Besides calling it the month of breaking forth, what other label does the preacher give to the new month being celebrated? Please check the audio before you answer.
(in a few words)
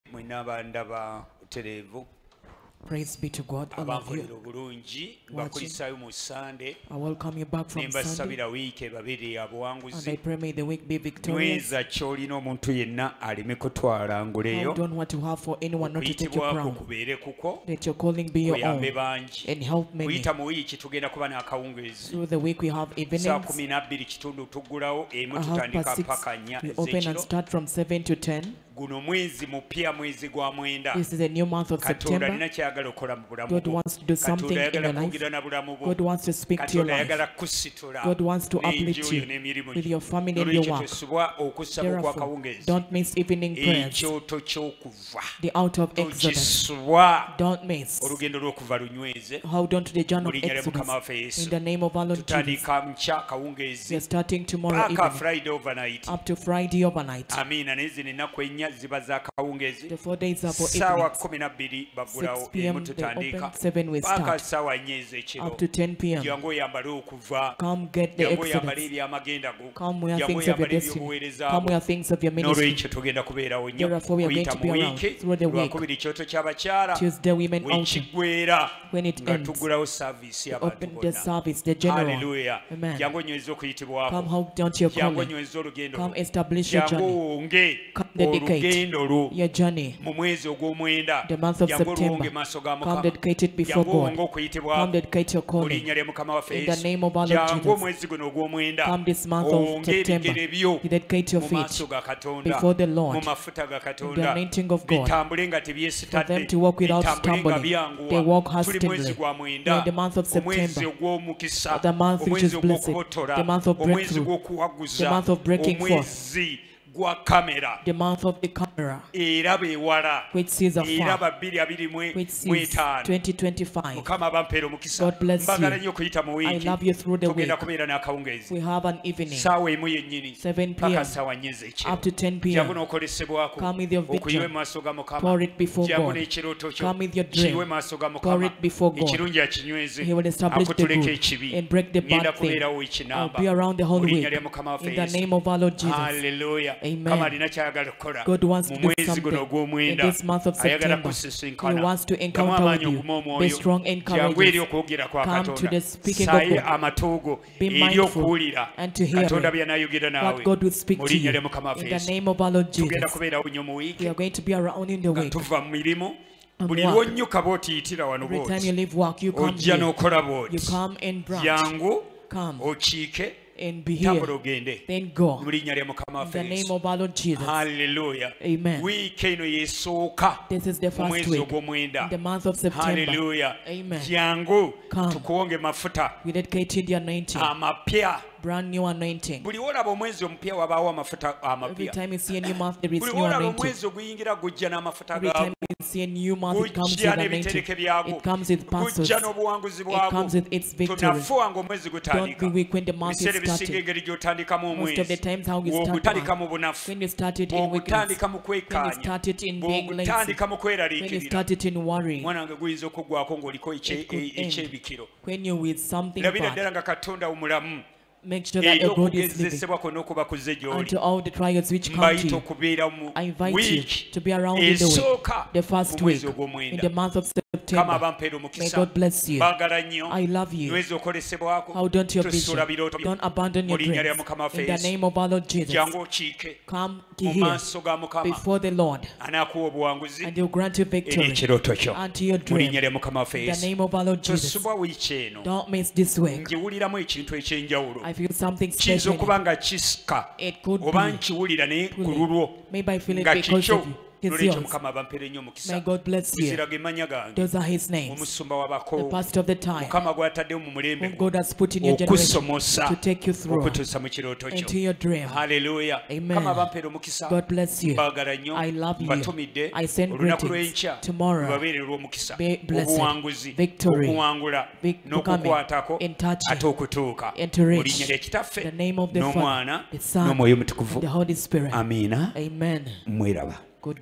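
month of breakthrough.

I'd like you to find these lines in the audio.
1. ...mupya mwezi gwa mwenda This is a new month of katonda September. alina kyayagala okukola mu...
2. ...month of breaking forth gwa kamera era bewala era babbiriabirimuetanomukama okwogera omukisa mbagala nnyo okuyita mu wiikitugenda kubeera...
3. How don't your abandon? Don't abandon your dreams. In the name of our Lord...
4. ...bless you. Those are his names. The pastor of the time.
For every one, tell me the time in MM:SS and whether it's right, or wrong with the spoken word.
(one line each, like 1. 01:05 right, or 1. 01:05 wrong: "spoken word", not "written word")
1. 00:29 right
2. 01:55 wrong: "abampeera", not "okwogera"
3. 03:51 wrong: "vision", not "abandon"
4. 04:16 right.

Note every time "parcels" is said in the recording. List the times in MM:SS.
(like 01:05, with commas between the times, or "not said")
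03:18.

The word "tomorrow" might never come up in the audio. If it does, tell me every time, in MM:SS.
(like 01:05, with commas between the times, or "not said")
00:54, 04:31.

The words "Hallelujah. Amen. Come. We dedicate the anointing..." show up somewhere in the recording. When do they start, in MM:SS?
03:03.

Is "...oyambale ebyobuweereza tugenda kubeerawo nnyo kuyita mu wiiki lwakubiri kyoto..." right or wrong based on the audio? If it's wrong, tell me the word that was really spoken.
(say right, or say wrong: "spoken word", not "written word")
right.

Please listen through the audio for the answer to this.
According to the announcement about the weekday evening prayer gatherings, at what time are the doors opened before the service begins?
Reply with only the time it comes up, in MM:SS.
00:23.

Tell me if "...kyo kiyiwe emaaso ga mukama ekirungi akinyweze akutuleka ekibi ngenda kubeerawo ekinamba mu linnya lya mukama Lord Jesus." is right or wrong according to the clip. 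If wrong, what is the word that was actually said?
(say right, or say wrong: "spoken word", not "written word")
right.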